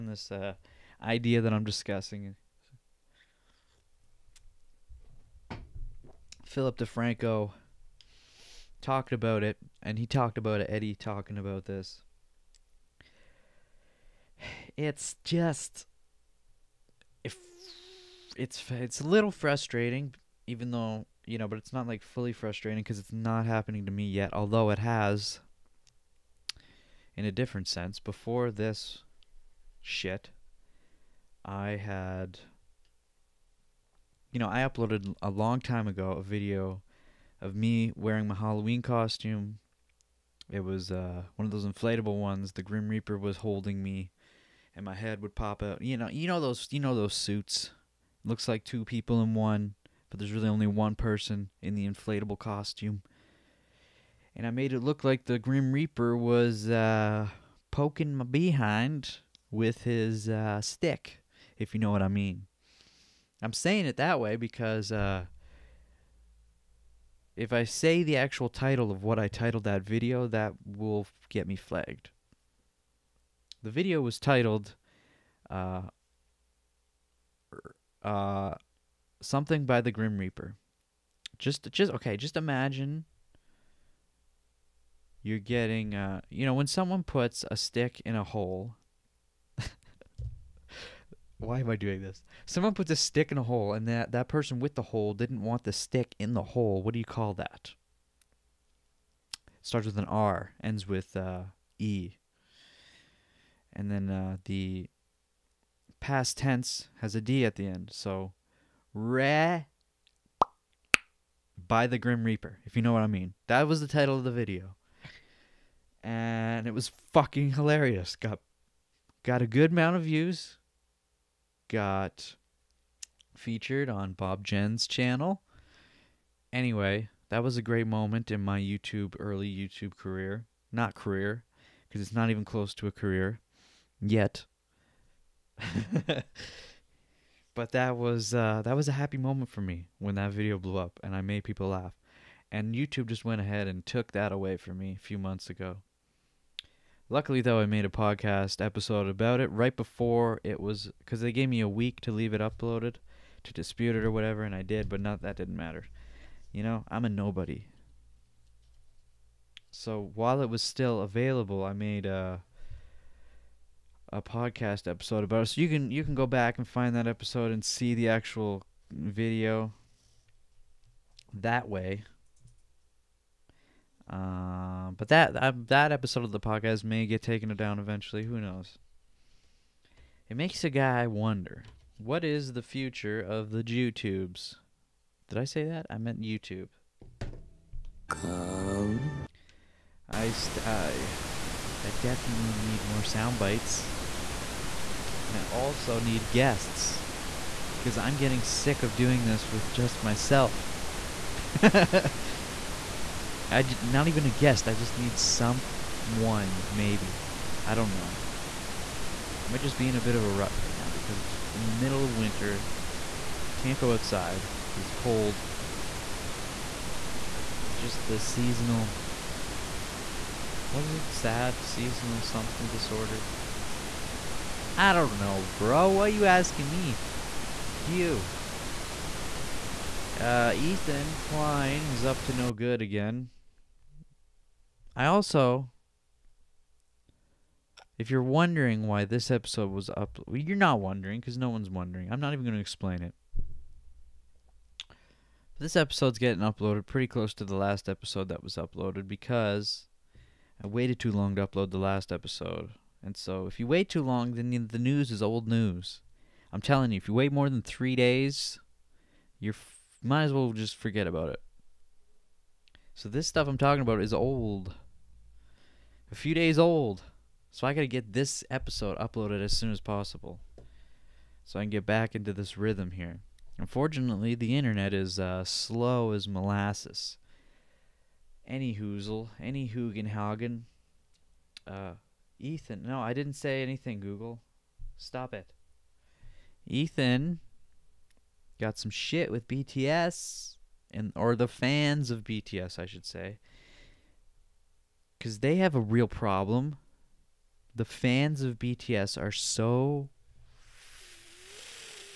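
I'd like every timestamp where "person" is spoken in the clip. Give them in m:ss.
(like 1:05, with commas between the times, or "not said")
0:50, 1:34.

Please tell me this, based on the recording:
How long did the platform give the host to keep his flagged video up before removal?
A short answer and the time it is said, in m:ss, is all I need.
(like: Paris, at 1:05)
a week, at 2:31.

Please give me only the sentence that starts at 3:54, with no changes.
I also, if you're wondering why this episode was up, well, you're not wondering because no one's wondering.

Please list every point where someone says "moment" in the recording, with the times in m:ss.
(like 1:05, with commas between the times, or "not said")
2:07, 2:19.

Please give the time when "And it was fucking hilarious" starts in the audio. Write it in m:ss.
1:56.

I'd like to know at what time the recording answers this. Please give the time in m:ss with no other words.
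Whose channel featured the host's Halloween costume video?
2:04.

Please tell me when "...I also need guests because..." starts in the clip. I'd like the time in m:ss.
3:15.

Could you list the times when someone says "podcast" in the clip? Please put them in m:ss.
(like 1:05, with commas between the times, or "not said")
2:27, 2:44, 2:56.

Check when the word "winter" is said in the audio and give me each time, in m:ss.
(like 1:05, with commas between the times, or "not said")
3:32.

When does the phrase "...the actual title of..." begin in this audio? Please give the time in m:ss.
1:08.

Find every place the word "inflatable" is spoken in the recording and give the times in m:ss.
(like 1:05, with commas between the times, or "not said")
0:41, 0:51.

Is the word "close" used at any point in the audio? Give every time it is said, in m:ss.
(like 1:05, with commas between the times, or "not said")
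2:12, 4:07.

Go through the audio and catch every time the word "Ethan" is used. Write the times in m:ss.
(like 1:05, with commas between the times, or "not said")
3:50, 4:42, 4:46.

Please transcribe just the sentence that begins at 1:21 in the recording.
Just, just okay, just imagine you're getting, uh, you know, when someone puts a stick in a hole.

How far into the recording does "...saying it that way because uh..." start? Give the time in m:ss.
1:03.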